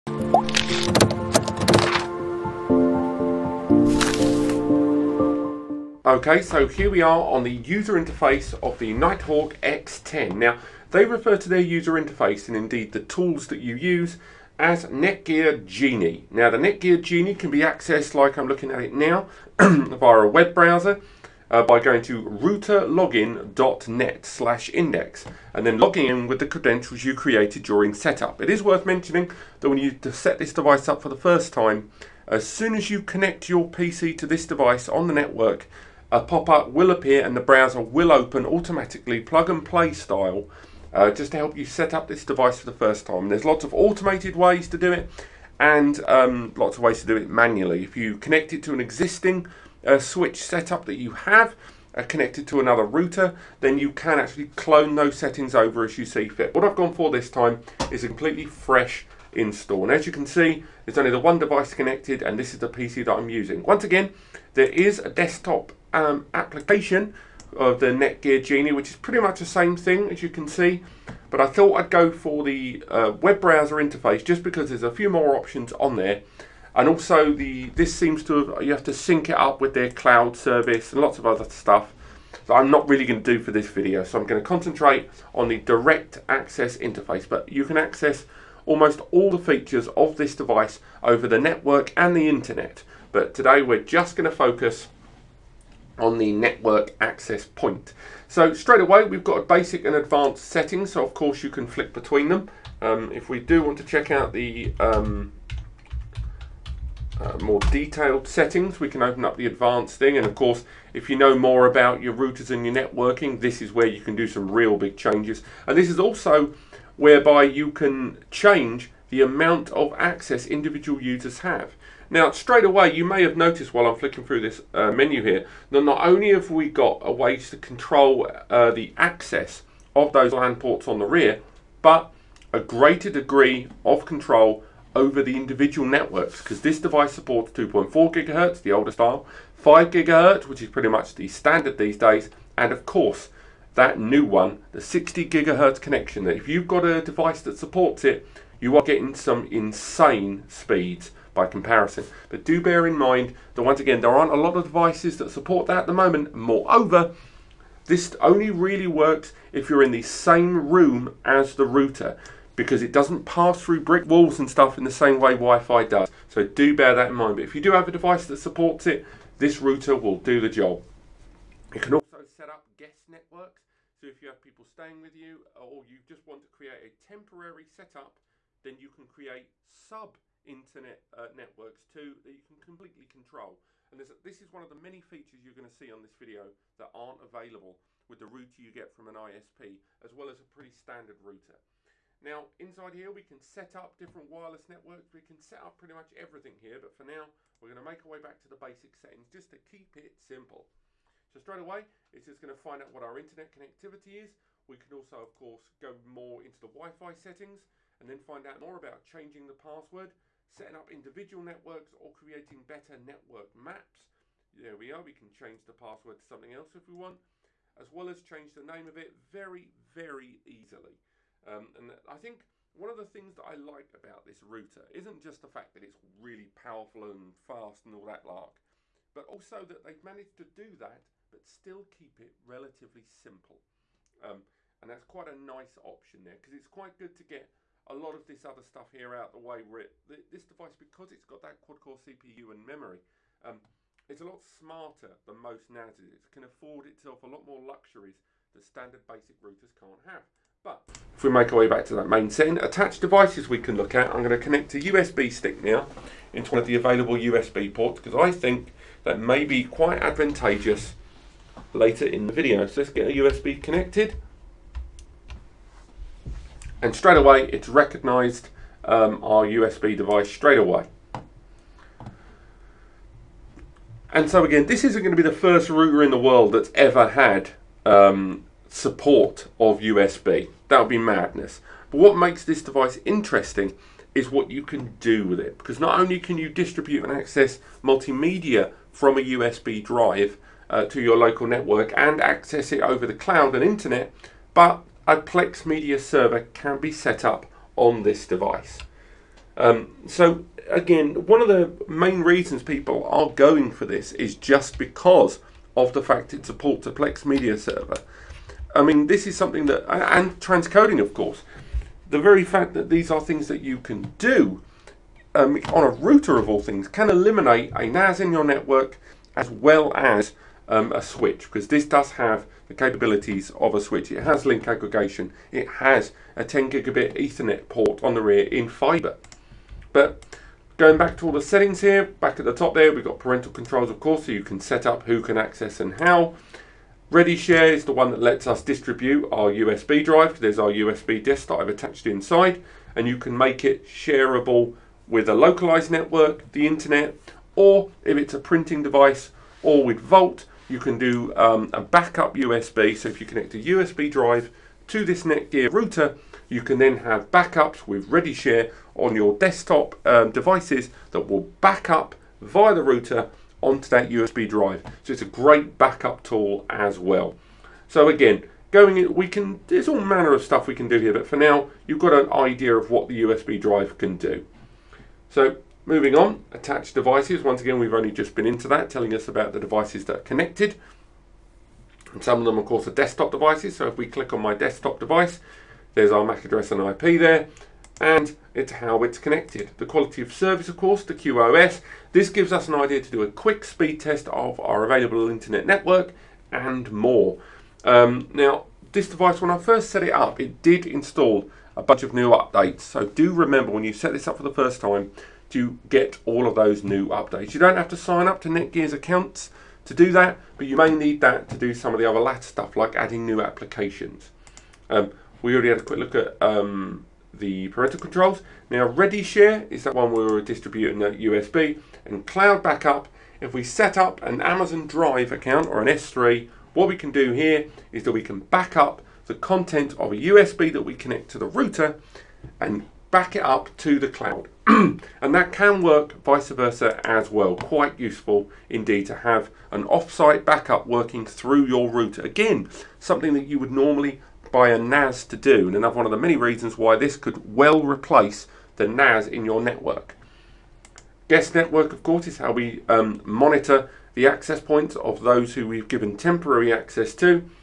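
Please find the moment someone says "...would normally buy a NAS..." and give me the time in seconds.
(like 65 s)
443 s.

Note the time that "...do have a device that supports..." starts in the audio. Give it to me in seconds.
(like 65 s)
167 s.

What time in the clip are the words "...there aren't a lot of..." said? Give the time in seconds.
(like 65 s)
154 s.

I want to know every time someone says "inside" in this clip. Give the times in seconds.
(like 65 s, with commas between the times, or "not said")
192 s, 342 s.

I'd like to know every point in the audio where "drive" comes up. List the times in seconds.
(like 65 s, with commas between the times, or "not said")
289 s, 340 s, 354 s, 364 s, 373 s, 424 s.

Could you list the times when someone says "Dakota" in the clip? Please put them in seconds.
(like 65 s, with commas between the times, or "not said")
not said.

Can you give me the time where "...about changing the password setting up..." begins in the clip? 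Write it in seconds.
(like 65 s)
208 s.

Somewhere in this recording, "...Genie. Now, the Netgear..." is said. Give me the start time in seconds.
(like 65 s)
15 s.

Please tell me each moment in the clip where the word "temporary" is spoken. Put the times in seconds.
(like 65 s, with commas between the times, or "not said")
176 s, 456 s.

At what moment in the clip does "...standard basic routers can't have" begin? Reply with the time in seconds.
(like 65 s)
248 s.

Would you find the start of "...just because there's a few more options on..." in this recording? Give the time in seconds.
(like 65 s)
74 s.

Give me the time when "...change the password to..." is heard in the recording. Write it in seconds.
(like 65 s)
215 s.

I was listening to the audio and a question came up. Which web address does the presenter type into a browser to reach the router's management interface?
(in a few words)
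routerlogin.net.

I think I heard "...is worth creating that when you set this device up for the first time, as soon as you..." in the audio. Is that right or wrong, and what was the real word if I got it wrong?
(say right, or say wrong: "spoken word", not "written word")
wrong: "mentioning", not "creating".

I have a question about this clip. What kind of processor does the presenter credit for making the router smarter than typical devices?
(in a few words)
quad-core CPU.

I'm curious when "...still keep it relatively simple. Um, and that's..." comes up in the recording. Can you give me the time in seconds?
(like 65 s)
231 s.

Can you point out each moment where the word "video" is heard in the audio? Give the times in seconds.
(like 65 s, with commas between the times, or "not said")
83 s, 186 s, 262 s.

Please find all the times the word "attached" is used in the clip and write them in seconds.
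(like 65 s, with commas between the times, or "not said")
252 s, 341 s, 376 s.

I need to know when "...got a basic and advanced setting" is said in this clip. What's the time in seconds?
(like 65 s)
99 s.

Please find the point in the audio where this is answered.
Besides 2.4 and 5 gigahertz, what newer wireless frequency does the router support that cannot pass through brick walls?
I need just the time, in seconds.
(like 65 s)
144 s.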